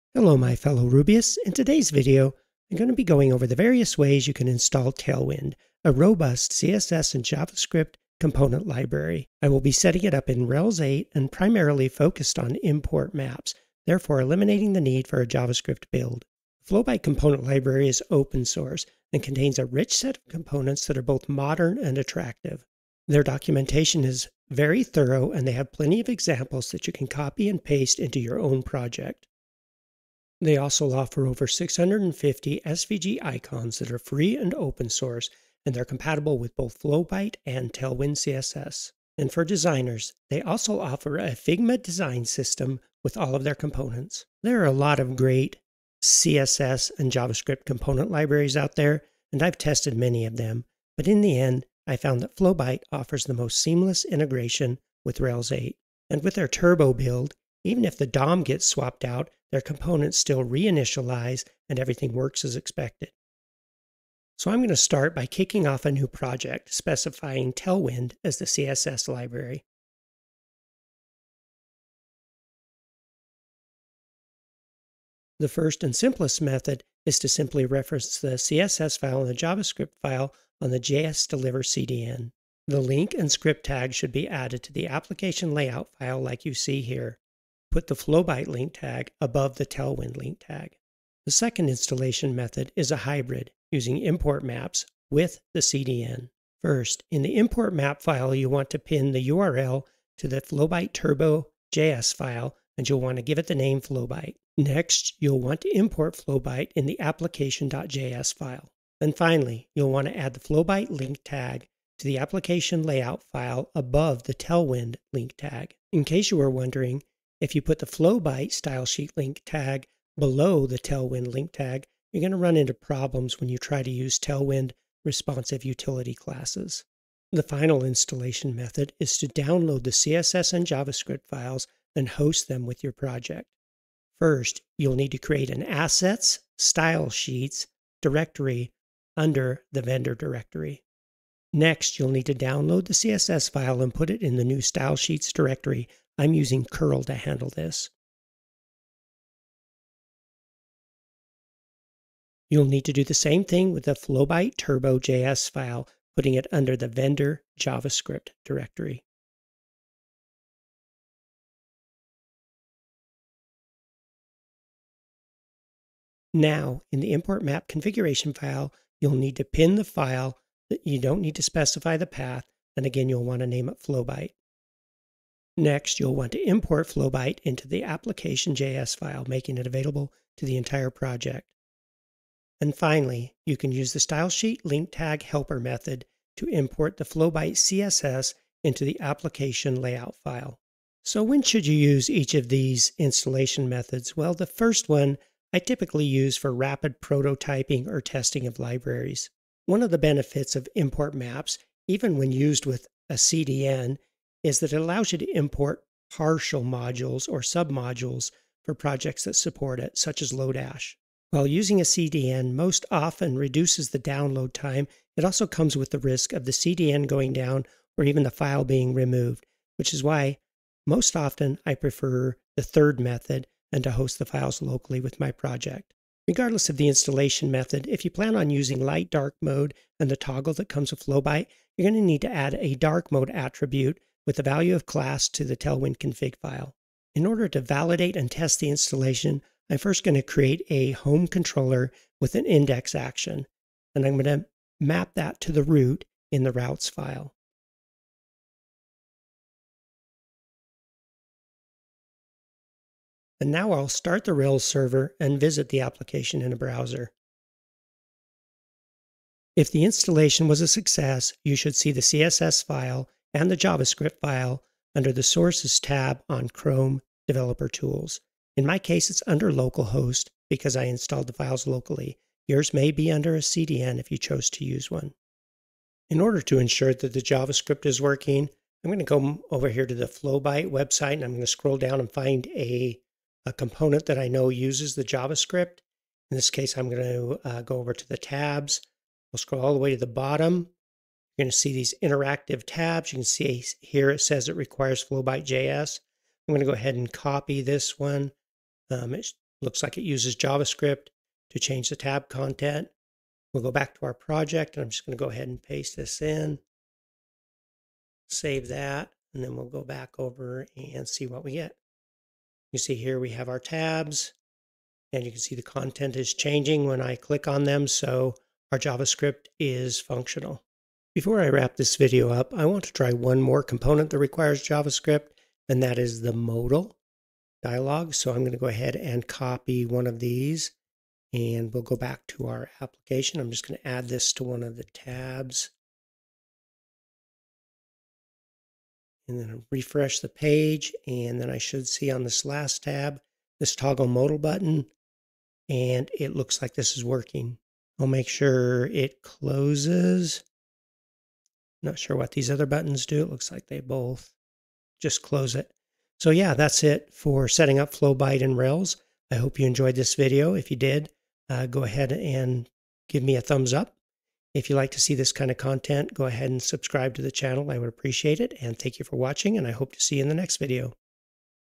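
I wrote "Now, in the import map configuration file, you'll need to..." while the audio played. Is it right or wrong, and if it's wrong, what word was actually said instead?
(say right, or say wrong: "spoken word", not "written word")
right.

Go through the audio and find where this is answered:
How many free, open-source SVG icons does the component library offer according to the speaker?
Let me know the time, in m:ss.
0:31.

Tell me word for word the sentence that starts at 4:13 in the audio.
And now I'll start the Rails server and visit the application in a browser.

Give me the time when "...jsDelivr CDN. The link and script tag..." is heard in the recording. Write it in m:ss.
1:20.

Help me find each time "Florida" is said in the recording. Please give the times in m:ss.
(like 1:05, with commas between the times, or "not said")
not said.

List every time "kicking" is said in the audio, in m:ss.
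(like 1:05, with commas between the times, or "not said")
1:05.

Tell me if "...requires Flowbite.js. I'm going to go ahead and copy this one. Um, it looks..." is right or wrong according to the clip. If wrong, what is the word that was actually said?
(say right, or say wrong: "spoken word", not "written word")
right.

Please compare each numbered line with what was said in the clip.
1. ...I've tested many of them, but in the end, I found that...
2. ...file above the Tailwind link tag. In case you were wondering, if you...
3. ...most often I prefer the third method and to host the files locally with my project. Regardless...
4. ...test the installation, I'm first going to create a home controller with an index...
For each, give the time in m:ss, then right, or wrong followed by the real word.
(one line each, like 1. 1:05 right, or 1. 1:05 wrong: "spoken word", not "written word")
1. 0:49 right
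2. 1:53 right
3. 3:40 right
4. 3:58 right.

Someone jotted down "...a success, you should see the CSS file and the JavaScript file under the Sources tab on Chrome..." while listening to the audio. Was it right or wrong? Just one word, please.
right.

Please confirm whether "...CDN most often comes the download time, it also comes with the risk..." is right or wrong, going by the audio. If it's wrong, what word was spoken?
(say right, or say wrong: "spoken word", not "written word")
wrong: "reduces", not "comes".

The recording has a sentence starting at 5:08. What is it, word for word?
Save that, and then we'll go back over and see what we get.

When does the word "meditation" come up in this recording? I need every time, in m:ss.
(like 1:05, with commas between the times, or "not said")
not said.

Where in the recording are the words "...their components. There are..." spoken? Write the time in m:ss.
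0:43.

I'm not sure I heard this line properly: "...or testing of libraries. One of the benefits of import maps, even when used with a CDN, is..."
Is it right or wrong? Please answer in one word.
right.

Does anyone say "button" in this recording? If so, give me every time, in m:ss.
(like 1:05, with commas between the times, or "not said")
5:44, 5:52.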